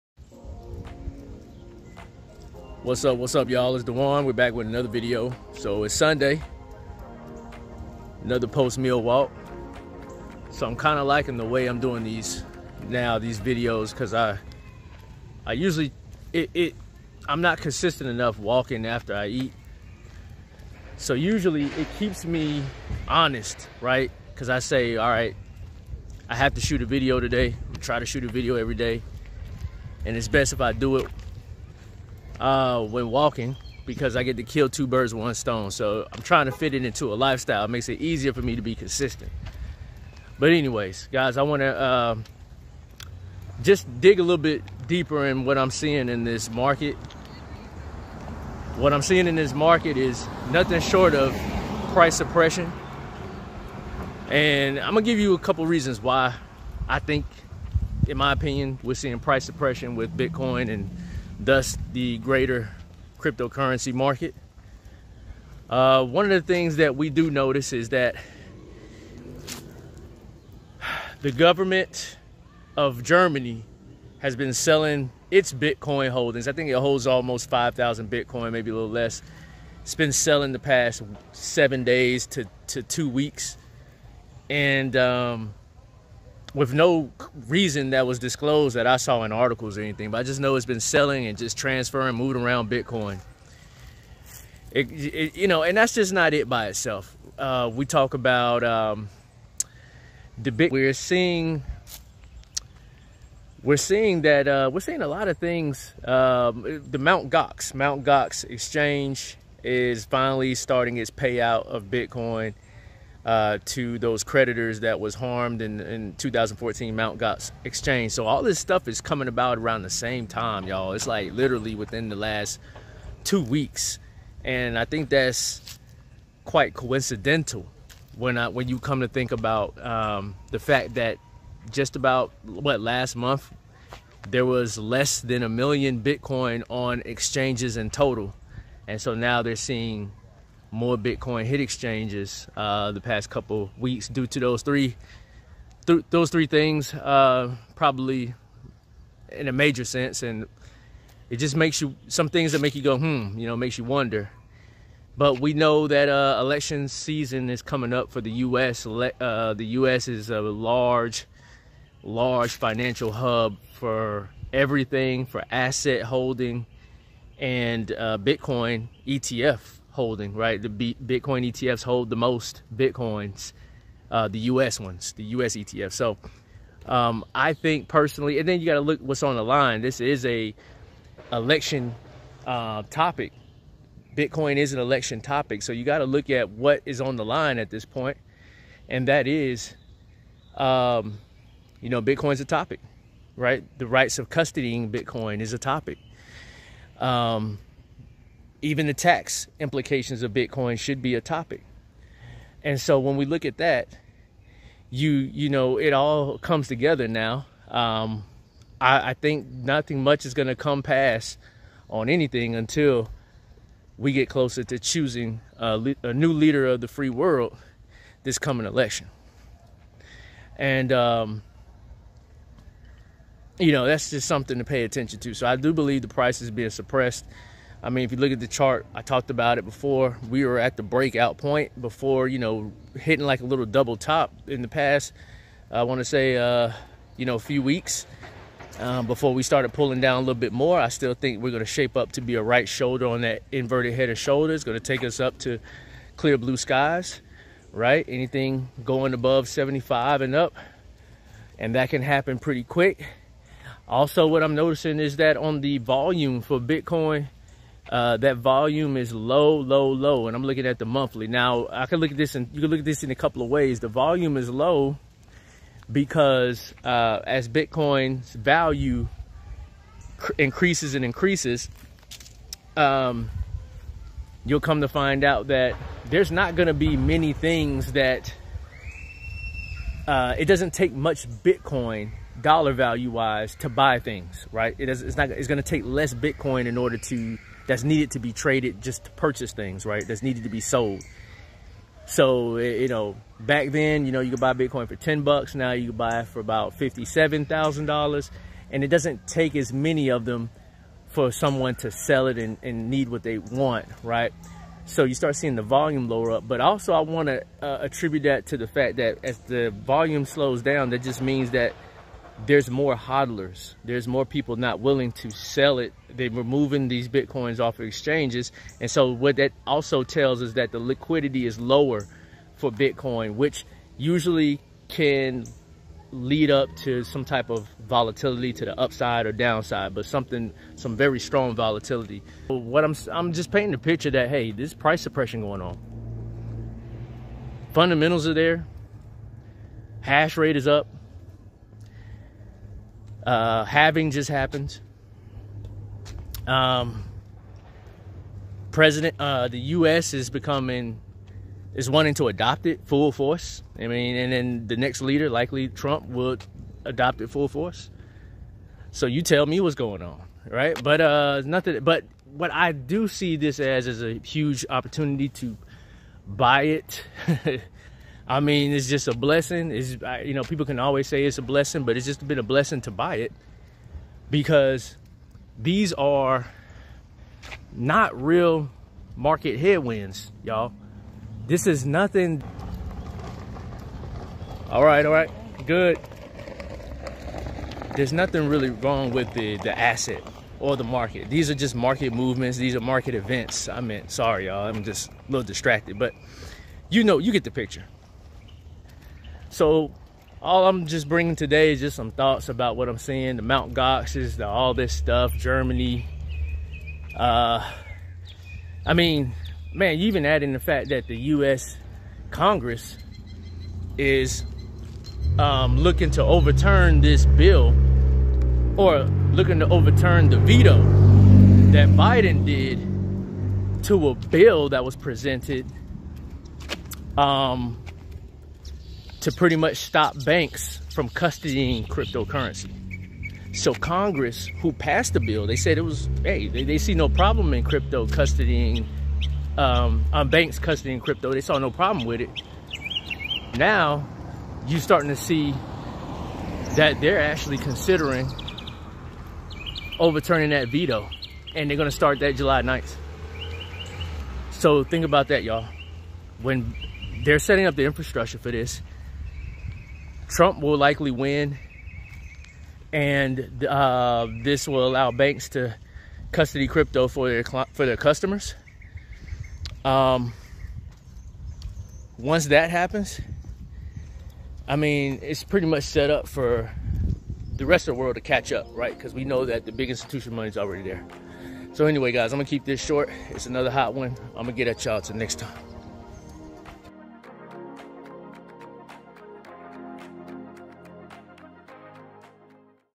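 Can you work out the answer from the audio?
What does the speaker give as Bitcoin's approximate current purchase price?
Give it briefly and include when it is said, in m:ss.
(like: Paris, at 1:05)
$57,000, at 4:56.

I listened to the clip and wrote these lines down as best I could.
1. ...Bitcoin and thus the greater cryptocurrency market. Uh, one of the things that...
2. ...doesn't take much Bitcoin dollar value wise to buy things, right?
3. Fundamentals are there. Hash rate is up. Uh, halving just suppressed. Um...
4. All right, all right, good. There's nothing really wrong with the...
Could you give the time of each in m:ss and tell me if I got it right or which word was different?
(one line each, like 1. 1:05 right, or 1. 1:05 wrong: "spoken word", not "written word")
1. 1:00 right
2. 4:40 right
3. 5:37 wrong: "happened", not "suppressed"
4. 6:24 right.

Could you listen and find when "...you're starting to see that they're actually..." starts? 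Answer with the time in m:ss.
7:24.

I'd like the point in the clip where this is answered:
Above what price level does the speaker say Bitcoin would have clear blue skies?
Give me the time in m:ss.
4:09.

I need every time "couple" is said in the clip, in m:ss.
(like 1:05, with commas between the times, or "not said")
0:55, 2:23, 4:23.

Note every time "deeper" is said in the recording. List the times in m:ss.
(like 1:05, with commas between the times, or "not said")
0:44.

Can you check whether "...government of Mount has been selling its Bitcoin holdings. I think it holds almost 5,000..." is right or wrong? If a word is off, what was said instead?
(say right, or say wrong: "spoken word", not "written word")
wrong: "Germany", not "Mount".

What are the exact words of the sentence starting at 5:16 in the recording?
They're removing these Bitcoins off of exchanges.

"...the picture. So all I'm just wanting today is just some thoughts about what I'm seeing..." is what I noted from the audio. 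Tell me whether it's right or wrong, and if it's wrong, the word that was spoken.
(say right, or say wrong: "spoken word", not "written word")
wrong: "bringing", not "wanting".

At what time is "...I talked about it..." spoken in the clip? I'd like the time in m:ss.
3:48.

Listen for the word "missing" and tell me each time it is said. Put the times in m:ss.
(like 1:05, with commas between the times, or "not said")
not said.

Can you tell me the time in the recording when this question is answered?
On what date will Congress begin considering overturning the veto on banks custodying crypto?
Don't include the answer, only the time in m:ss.
7:32.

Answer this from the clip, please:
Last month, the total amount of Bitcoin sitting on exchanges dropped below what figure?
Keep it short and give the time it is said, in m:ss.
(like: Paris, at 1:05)
1 million, at 2:15.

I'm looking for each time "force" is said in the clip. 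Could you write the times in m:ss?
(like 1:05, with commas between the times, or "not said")
5:53, 5:57.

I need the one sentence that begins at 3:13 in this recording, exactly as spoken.
The rights of custodying Bitcoin is a topic.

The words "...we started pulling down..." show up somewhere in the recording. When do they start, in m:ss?
3:59.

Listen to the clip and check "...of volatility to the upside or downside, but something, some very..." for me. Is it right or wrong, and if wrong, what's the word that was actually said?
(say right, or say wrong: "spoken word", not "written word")
right.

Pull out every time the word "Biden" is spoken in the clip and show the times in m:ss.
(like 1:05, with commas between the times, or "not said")
7:01.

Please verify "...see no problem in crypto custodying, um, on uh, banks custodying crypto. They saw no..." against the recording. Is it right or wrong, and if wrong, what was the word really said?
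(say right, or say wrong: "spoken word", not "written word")
right.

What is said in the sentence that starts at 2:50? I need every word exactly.
The B Bitcoin ETFs hold the most Bitcoins, uh, the US ones, the US ETF.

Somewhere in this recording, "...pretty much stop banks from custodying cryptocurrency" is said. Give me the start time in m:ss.
7:09.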